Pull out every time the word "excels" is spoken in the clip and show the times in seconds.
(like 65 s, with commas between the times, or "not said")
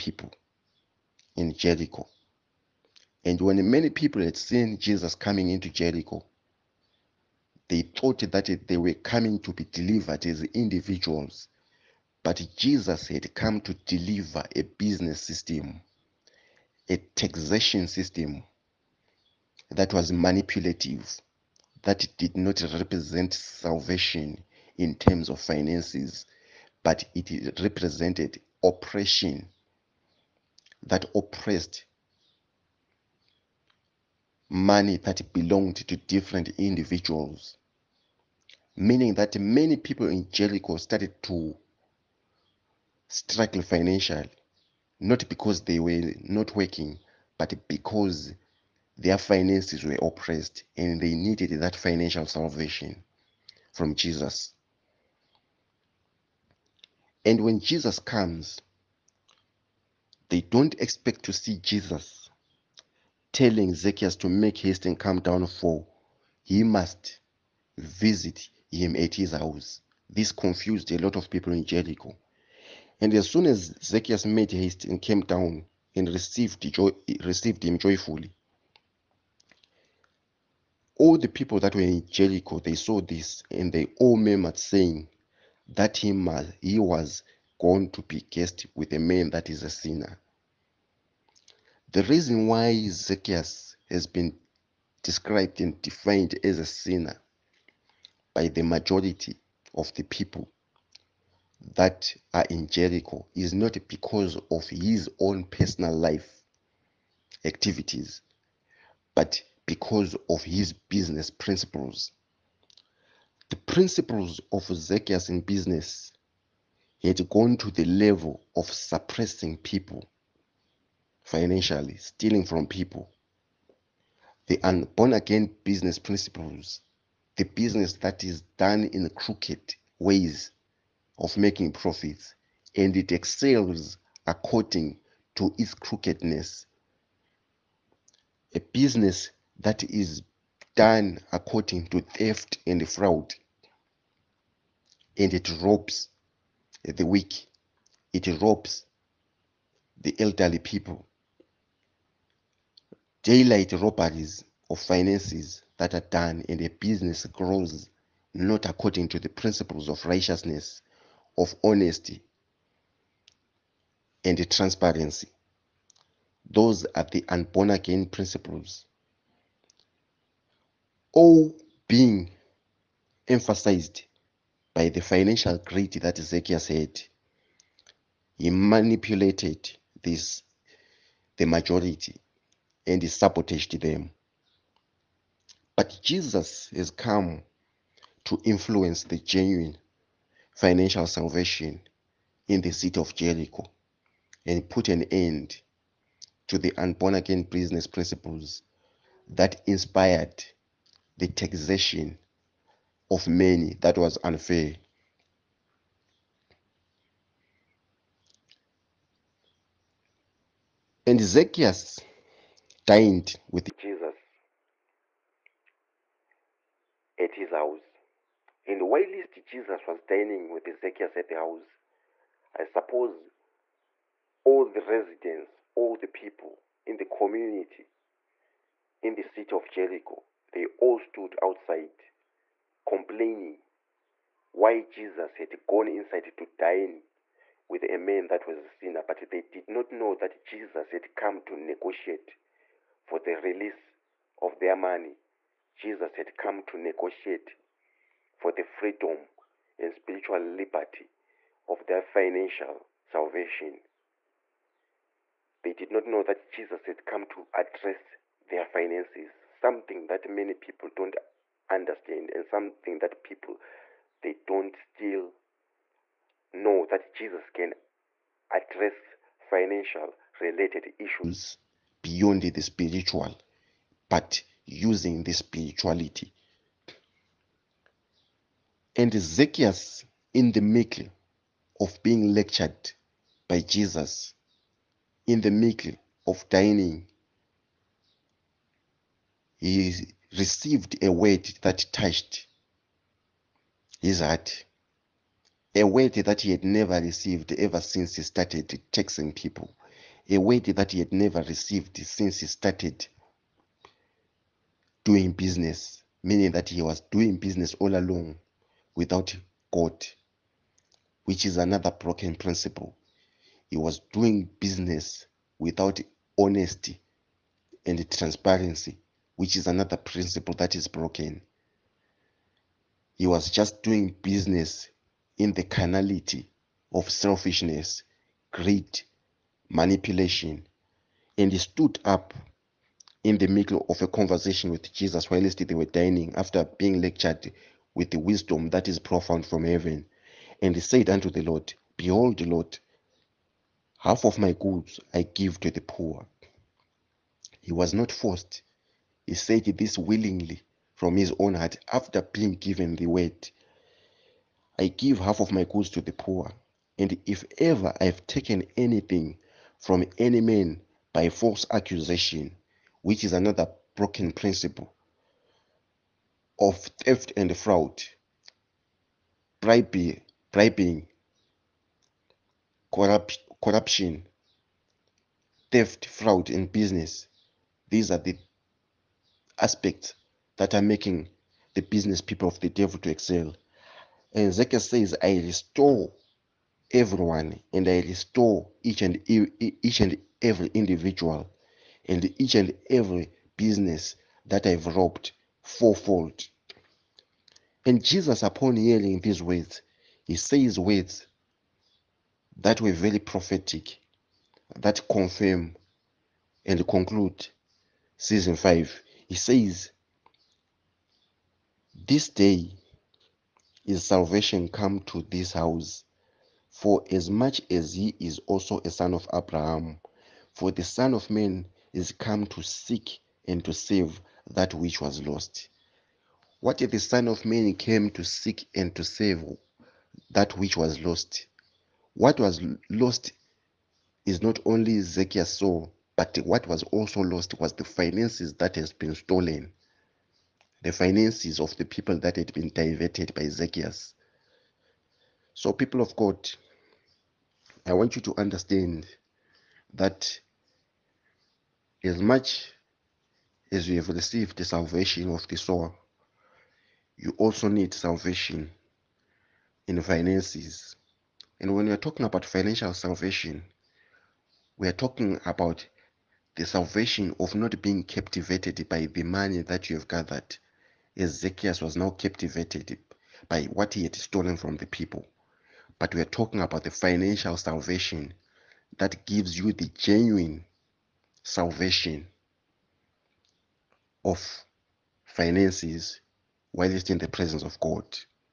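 133 s, 383 s.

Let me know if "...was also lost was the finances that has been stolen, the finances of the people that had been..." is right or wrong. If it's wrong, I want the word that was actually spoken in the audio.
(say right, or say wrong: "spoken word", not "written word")
right.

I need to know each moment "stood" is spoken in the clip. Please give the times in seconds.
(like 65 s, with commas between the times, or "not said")
230 s, 331 s.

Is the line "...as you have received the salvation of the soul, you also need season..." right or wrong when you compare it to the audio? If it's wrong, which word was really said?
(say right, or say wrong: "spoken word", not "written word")
wrong: "salvation", not "season".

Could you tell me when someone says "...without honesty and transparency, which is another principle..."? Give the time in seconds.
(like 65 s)
315 s.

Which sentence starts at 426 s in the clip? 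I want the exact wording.
What if the Son of Man came to seek and to save that which was lost?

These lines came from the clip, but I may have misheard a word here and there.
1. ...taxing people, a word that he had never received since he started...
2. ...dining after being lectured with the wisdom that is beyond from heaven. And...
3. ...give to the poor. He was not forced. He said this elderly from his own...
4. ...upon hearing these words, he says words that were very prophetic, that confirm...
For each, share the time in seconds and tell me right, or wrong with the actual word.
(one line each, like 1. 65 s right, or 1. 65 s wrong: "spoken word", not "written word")
1. 298 s right
2. 335 s wrong: "profound", not "beyond"
3. 345 s wrong: "willingly", not "elderly"
4. 398 s right.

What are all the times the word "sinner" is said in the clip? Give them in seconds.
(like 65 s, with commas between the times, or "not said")
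89 s, 96 s, 238 s.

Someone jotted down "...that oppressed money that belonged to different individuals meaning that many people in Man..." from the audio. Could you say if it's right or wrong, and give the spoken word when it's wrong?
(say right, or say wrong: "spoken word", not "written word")
wrong: "Jericho", not "Man".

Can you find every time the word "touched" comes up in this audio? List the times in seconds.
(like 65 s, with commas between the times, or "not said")
291 s.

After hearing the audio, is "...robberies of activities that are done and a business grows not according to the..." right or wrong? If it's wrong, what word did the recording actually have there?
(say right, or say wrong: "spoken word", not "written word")
wrong: "finances", not "activities".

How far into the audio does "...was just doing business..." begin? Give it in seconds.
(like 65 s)
323 s.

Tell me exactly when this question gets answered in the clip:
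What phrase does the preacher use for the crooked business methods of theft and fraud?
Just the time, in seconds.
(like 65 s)
167 s.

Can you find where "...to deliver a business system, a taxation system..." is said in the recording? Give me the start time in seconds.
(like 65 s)
13 s.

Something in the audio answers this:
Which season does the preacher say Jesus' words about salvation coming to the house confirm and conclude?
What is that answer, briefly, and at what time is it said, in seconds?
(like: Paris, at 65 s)
season 5, at 408 s.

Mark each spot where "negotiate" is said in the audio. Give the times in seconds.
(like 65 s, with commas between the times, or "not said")
241 s, 246 s.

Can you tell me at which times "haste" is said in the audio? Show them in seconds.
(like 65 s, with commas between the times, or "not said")
64 s, 74 s.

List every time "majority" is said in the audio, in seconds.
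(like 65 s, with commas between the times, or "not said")
98 s, 181 s.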